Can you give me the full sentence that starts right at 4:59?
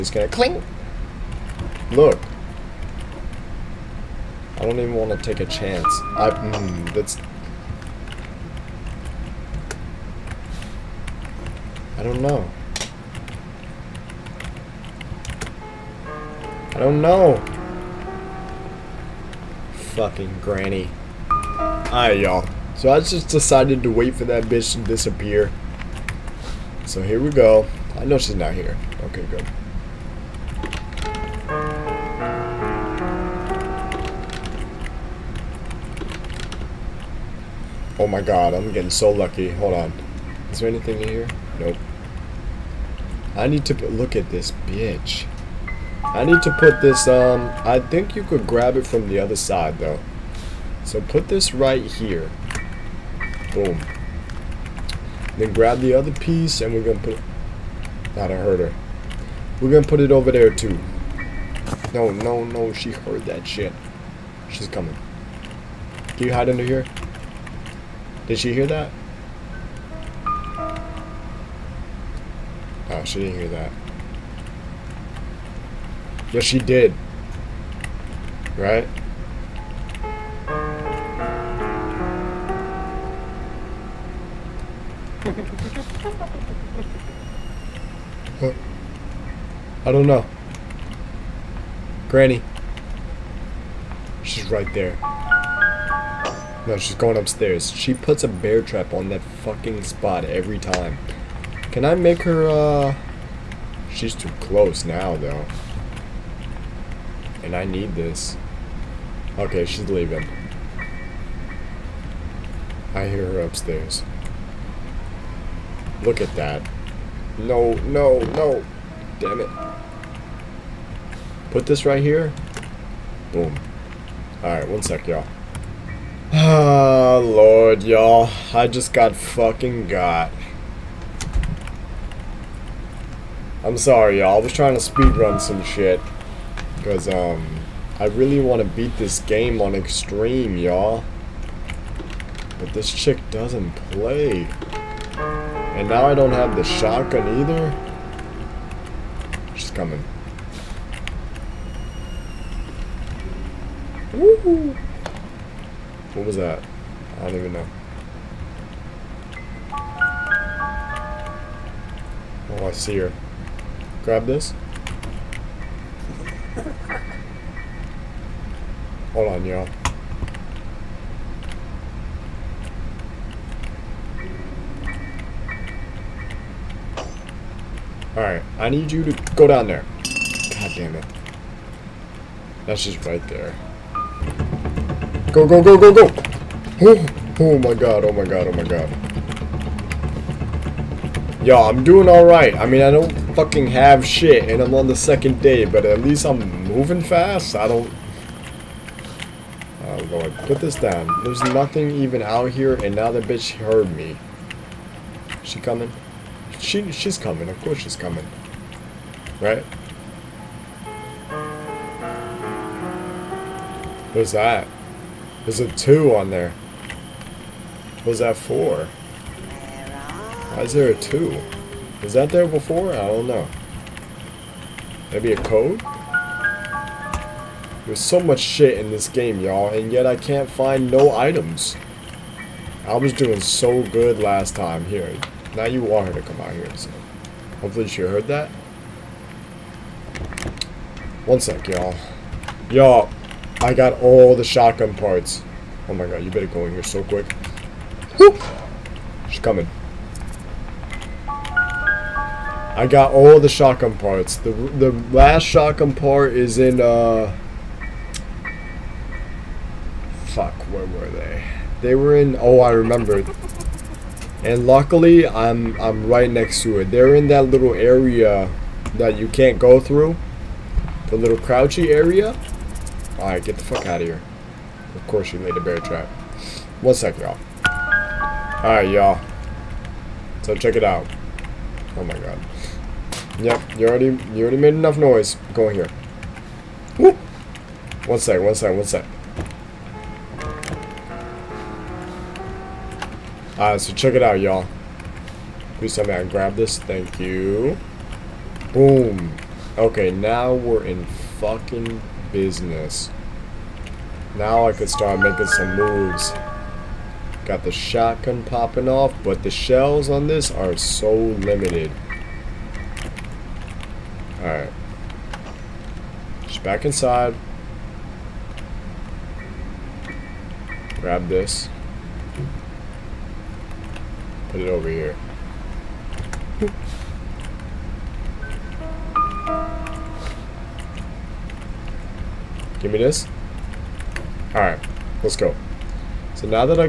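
Okay, now we're in fucking business.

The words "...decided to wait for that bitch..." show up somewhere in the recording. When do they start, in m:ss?
0:23.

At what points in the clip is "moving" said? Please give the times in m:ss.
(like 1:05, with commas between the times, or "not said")
3:16.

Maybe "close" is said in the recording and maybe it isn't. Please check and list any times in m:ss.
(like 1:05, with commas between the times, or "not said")
1:44.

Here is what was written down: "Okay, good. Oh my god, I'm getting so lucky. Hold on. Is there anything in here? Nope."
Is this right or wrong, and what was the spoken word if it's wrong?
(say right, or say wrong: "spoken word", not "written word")
right.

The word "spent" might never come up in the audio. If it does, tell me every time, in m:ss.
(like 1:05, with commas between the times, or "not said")
not said.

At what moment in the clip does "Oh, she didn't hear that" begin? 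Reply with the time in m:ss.
1:12.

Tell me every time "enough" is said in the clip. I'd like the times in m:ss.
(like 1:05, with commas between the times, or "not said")
4:44.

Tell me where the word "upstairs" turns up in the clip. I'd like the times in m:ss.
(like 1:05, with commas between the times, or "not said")
1:37, 1:53.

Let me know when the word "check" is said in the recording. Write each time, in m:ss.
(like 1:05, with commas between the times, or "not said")
4:40, 4:53.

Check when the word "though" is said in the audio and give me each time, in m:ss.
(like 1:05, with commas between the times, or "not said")
0:49, 1:45.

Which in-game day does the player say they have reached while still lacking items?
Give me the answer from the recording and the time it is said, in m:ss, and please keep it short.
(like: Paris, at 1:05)
Second day, at 3:14.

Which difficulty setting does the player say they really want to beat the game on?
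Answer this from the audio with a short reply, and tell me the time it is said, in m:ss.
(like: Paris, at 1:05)
Extreme, at 2:19.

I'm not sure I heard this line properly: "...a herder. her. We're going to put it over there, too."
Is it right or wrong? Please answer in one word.
right.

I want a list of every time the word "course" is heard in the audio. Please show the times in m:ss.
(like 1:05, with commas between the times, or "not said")
3:27, 4:35.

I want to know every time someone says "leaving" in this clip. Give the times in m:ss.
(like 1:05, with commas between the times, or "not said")
1:49.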